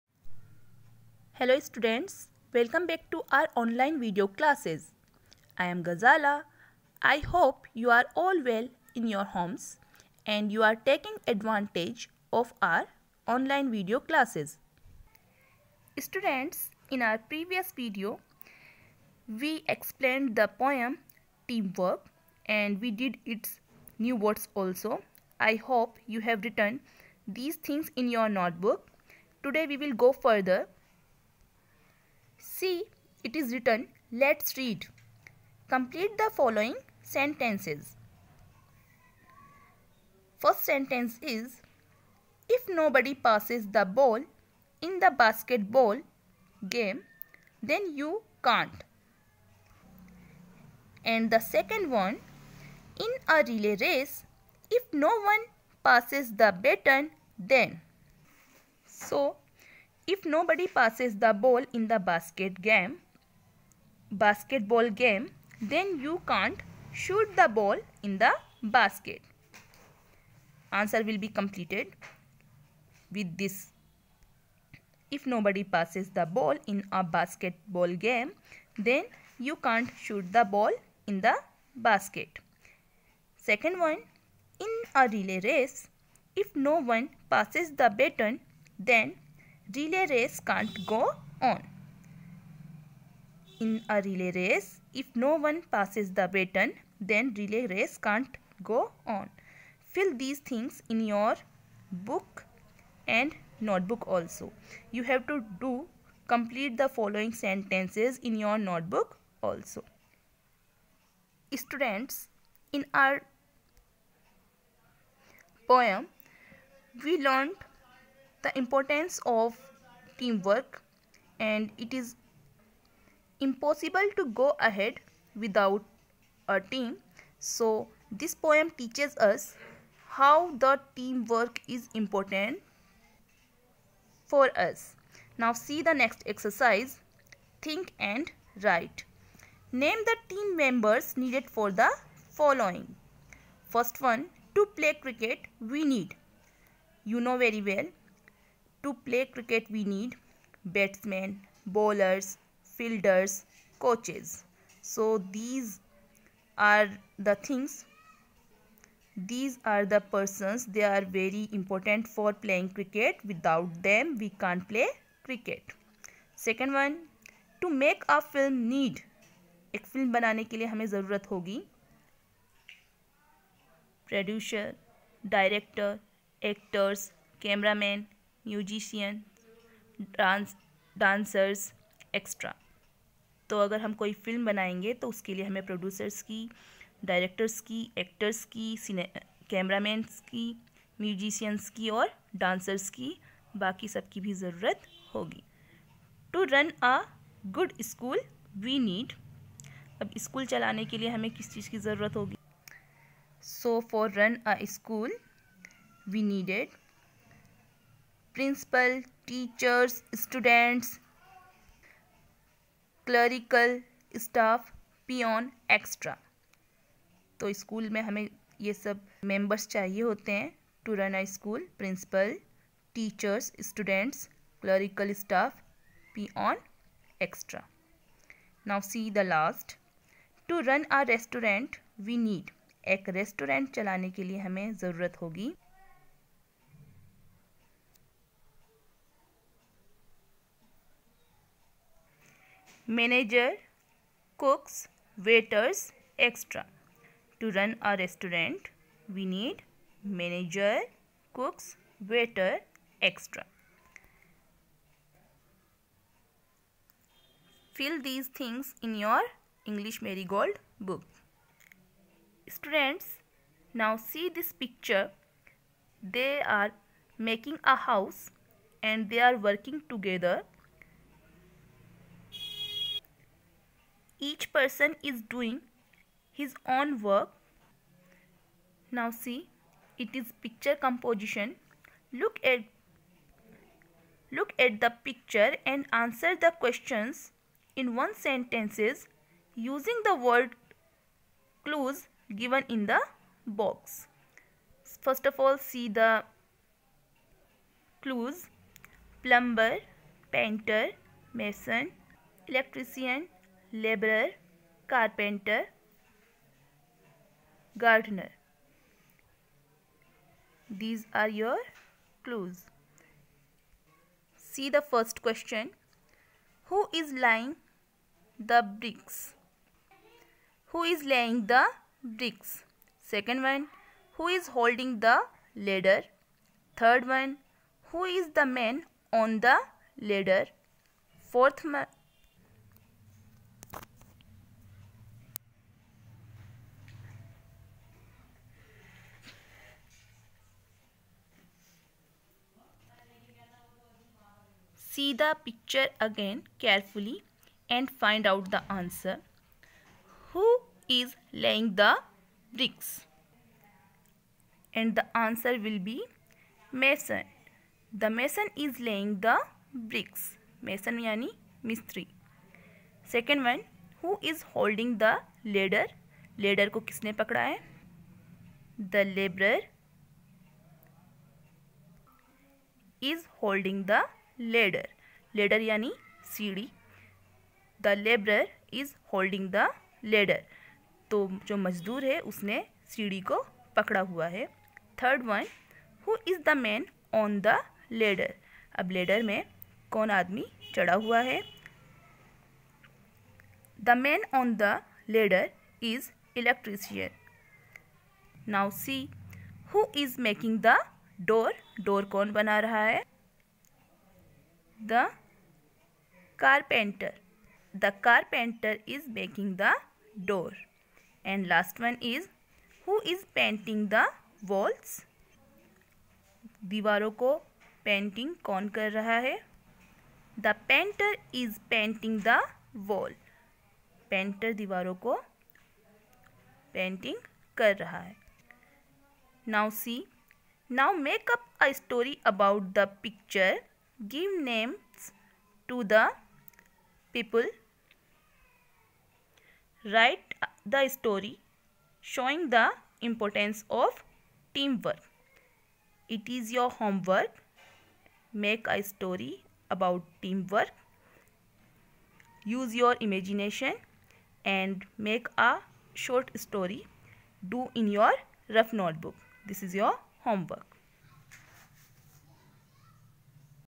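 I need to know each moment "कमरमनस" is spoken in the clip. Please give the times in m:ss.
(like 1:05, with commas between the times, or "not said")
3:09.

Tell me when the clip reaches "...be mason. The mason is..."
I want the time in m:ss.
5:55.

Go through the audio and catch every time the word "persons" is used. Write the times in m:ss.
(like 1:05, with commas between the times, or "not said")
2:39, 4:34.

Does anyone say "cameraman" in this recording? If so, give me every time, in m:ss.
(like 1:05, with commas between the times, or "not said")
2:57.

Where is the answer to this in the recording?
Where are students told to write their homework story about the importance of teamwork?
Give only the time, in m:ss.
7:38.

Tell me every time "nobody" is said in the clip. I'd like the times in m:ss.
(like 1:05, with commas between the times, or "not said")
0:42, 1:00, 1:15.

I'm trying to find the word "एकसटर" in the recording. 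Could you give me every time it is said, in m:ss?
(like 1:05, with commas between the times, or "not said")
3:02, 3:35, 3:47.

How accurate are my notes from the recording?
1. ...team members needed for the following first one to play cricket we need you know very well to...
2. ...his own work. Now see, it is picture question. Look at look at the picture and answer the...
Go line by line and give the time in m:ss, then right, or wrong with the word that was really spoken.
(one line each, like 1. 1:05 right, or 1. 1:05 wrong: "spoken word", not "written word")
1. 2:20 right
2. 4:36 wrong: "composition", not "question".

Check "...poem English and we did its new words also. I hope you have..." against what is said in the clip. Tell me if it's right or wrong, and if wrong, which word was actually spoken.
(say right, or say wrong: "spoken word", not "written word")
wrong: "Teamwork", not "English".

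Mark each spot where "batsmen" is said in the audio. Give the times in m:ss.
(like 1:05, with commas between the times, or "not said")
2:30.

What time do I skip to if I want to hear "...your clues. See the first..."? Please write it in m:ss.
5:11.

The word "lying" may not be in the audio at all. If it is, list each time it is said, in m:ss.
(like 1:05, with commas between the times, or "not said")
5:17.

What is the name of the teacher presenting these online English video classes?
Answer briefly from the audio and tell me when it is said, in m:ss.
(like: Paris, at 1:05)
Ghazala, at 0:05.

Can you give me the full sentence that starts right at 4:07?
To run a restaurant, we need manager, cooks, waiter, extra.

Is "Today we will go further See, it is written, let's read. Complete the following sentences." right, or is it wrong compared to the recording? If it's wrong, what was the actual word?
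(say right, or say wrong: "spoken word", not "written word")
right.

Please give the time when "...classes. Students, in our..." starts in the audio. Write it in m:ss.
0:14.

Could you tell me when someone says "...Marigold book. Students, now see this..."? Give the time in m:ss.
4:20.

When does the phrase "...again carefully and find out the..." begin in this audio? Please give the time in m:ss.
5:46.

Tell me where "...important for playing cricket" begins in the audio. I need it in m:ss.
2:41.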